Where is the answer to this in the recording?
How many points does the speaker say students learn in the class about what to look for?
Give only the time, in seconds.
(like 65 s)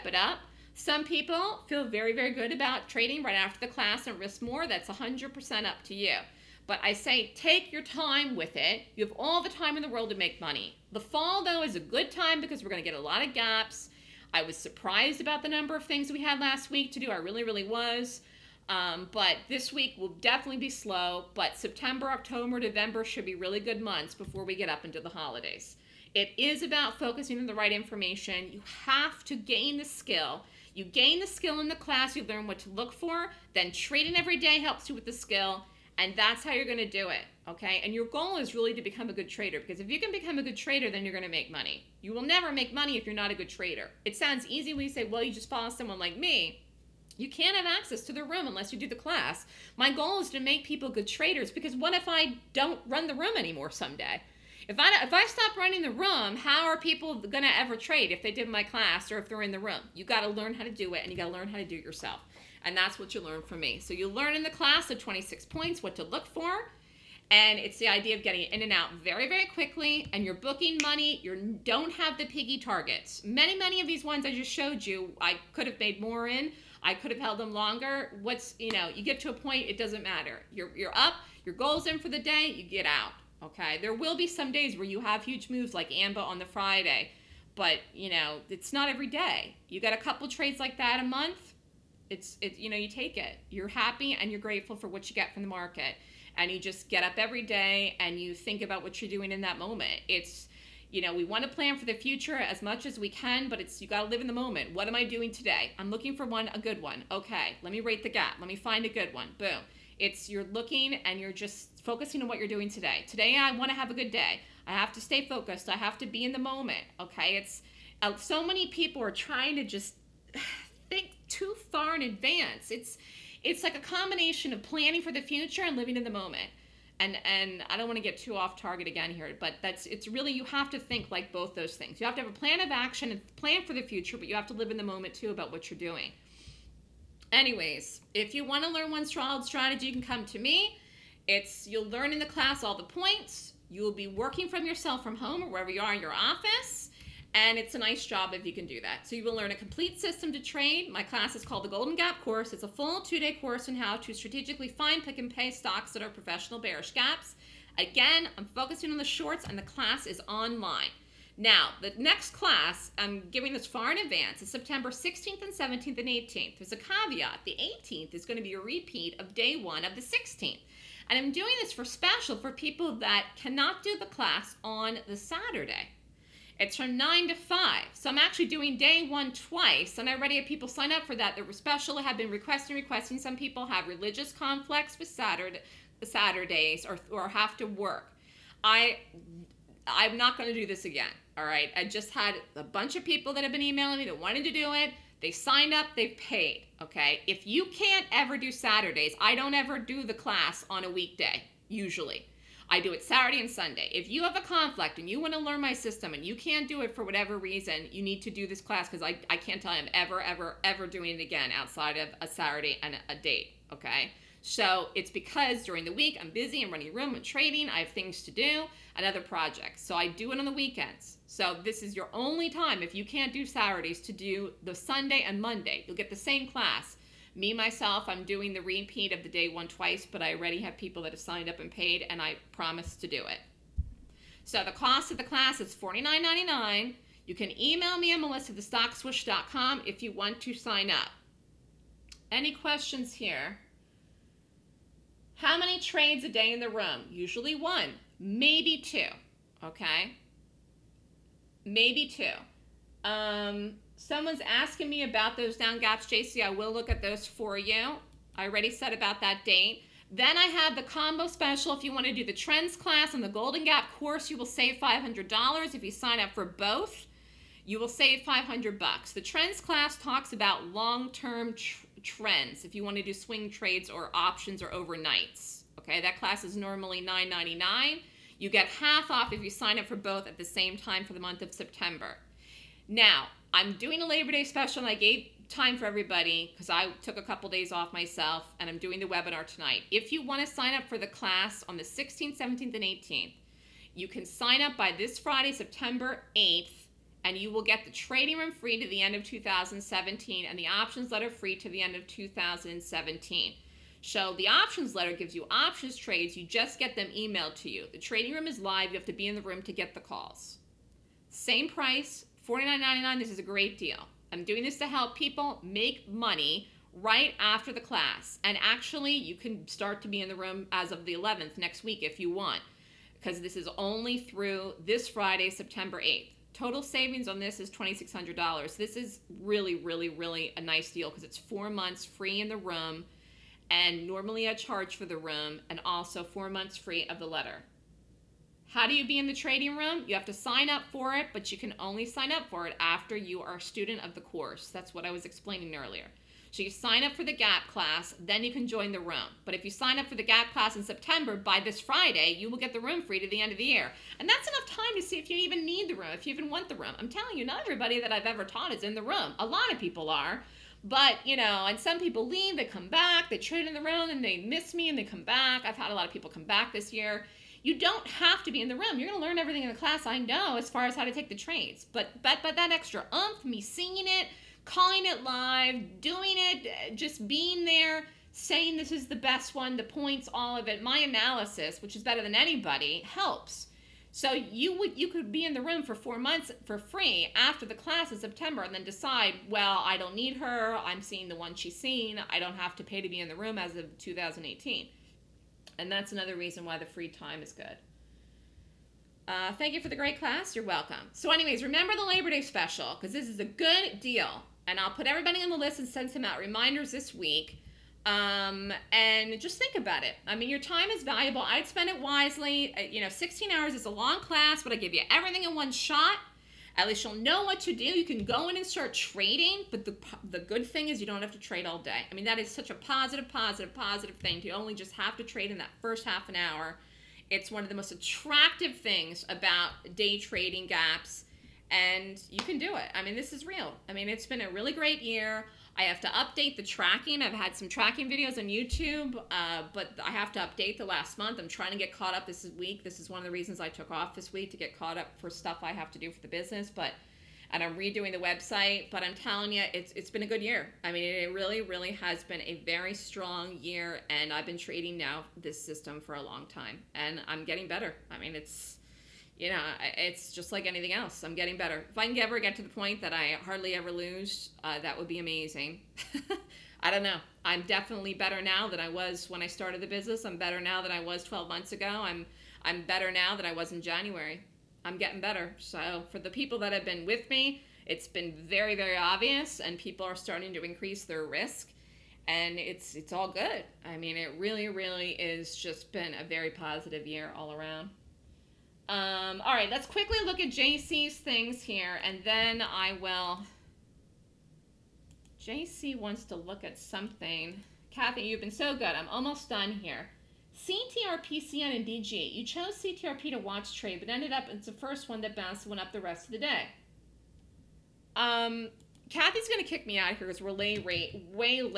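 64 s.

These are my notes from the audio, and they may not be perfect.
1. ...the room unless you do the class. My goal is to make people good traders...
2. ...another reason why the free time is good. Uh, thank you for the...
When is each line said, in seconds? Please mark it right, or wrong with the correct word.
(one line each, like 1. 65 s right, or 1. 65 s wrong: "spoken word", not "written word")
1. 48 s right
2. 396 s right.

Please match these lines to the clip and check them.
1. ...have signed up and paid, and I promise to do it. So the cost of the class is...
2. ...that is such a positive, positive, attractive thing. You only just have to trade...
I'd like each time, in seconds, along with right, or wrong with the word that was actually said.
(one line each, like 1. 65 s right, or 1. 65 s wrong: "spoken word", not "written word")
1. 231 s right
2. 422 s wrong: "positive", not "attractive".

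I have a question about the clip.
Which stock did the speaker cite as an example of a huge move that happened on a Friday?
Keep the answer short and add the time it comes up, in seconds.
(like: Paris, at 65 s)
AMBA, at 85 s.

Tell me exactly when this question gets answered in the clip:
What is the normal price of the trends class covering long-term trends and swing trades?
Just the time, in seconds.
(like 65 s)
277 s.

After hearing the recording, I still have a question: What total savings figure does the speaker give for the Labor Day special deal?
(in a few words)
$2,600.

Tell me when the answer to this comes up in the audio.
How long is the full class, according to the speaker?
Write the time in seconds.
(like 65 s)
413 s.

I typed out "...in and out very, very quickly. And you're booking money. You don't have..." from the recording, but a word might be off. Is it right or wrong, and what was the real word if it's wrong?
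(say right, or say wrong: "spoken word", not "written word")
right.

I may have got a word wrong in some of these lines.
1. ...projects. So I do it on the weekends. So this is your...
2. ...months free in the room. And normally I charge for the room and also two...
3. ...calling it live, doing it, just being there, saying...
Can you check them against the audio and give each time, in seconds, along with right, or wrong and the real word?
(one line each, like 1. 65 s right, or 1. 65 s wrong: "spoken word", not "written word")
1. 219 s right
2. 331 s wrong: "four", not "two"
3. 374 s right.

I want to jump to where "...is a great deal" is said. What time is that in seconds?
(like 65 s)
313 s.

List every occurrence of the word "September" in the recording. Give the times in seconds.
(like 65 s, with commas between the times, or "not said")
21 s, 164 s, 281 s, 295 s, 325 s, 350 s, 388 s.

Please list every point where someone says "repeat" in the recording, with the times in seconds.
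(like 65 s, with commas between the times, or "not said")
168 s, 228 s.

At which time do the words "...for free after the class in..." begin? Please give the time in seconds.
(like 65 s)
386 s.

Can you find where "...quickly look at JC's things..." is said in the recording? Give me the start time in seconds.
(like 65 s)
489 s.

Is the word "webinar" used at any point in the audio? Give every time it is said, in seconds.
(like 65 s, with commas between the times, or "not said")
289 s.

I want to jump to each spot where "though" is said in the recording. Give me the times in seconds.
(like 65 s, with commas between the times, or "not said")
11 s.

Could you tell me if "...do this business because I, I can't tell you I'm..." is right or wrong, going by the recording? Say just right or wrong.
wrong.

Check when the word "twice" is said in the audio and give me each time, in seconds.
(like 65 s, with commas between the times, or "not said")
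179 s, 229 s.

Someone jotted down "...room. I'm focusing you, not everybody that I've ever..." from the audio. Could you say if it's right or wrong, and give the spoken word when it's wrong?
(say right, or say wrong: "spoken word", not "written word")
wrong: "telling", not "focusing".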